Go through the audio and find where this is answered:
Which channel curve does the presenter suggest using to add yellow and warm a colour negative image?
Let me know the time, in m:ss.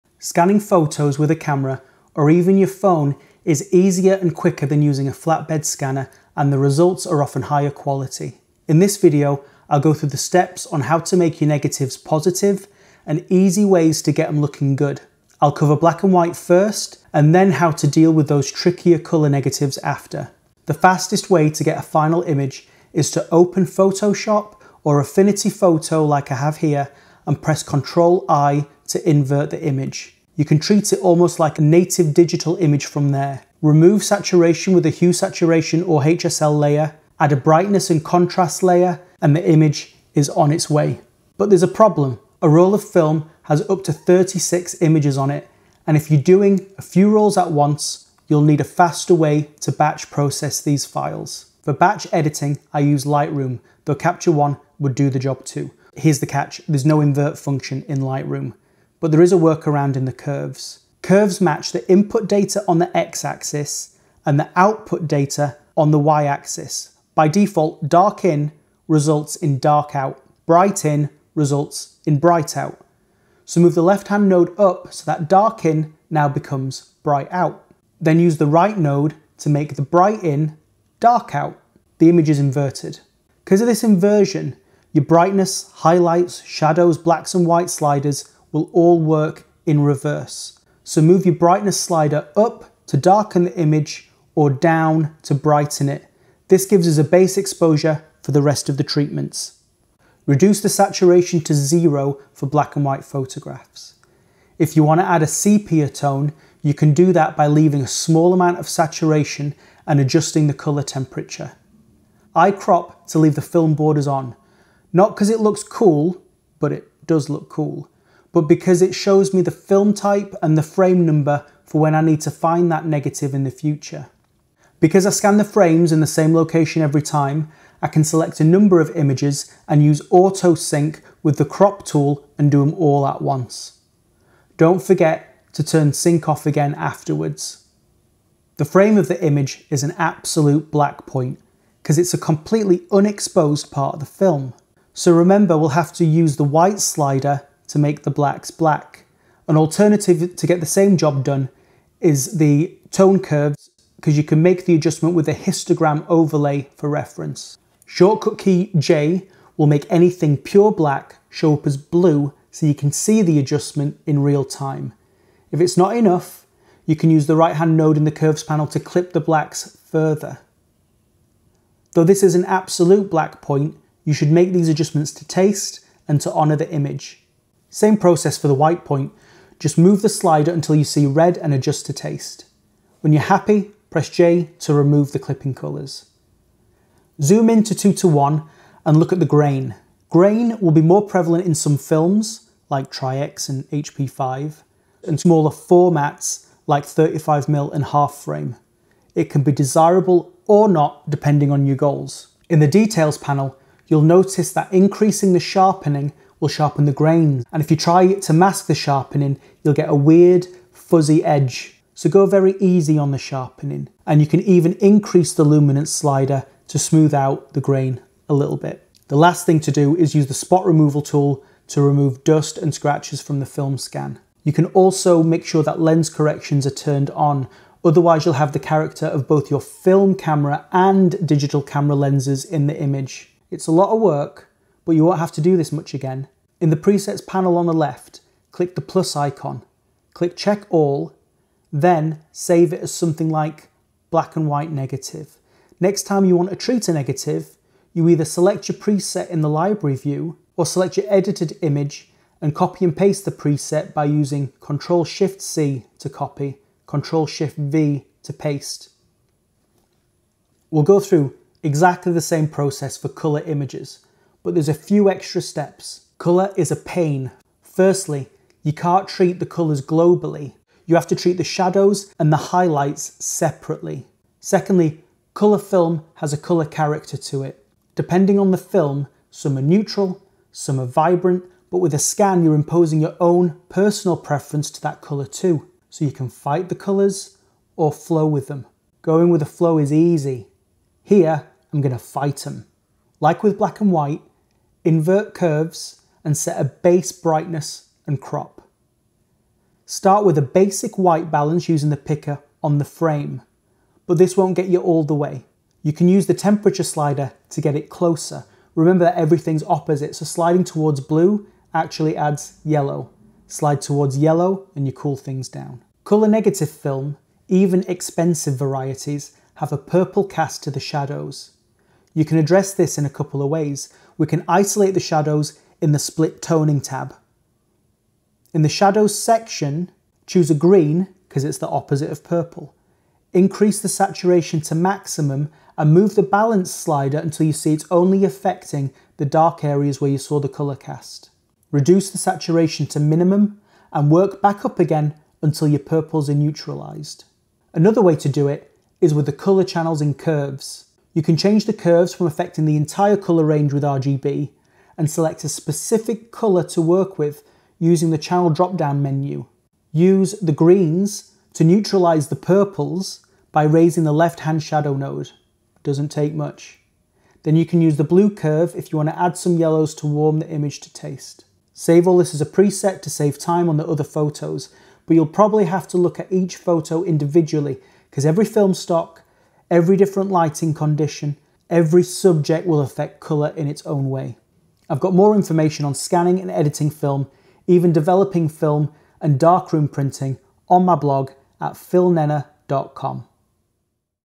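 6:08.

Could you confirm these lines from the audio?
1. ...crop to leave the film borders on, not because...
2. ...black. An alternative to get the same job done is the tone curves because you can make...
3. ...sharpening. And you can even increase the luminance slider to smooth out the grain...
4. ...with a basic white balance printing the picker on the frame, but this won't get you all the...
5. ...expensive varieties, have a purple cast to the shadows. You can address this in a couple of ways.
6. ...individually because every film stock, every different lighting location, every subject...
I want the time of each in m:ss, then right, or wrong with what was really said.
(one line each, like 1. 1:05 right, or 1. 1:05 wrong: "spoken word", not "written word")
1. 1:52 right
2. 2:28 right
3. 3:33 right
4. 5:00 wrong: "using", not "printing"
5. 5:17 right
6. 6:17 wrong: "condition", not "location".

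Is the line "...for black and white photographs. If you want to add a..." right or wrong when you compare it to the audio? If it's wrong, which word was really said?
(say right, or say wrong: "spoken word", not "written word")
right.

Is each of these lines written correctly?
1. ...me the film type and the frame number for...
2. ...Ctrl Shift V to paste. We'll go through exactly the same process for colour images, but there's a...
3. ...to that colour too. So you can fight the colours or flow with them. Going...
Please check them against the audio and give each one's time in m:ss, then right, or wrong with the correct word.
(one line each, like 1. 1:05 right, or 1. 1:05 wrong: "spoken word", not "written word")
1. 1:59 right
2. 4:16 right
3. 4:44 right.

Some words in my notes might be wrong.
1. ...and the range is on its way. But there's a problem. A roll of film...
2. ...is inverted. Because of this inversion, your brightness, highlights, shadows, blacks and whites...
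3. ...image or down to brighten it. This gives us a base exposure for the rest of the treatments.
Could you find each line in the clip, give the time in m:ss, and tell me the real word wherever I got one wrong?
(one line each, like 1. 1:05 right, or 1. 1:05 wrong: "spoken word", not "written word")
1. 0:39 wrong: "image", not "range"
2. 1:22 right
3. 1:33 right.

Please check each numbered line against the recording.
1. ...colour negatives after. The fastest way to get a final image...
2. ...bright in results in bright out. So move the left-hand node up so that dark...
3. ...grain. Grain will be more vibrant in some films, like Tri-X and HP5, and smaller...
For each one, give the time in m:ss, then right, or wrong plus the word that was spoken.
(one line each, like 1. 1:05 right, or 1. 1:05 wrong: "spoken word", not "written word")
1. 0:18 right
2. 1:10 right
3. 3:09 wrong: "prevalent", not "vibrant".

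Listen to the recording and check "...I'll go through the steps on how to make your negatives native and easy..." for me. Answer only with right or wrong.
wrong.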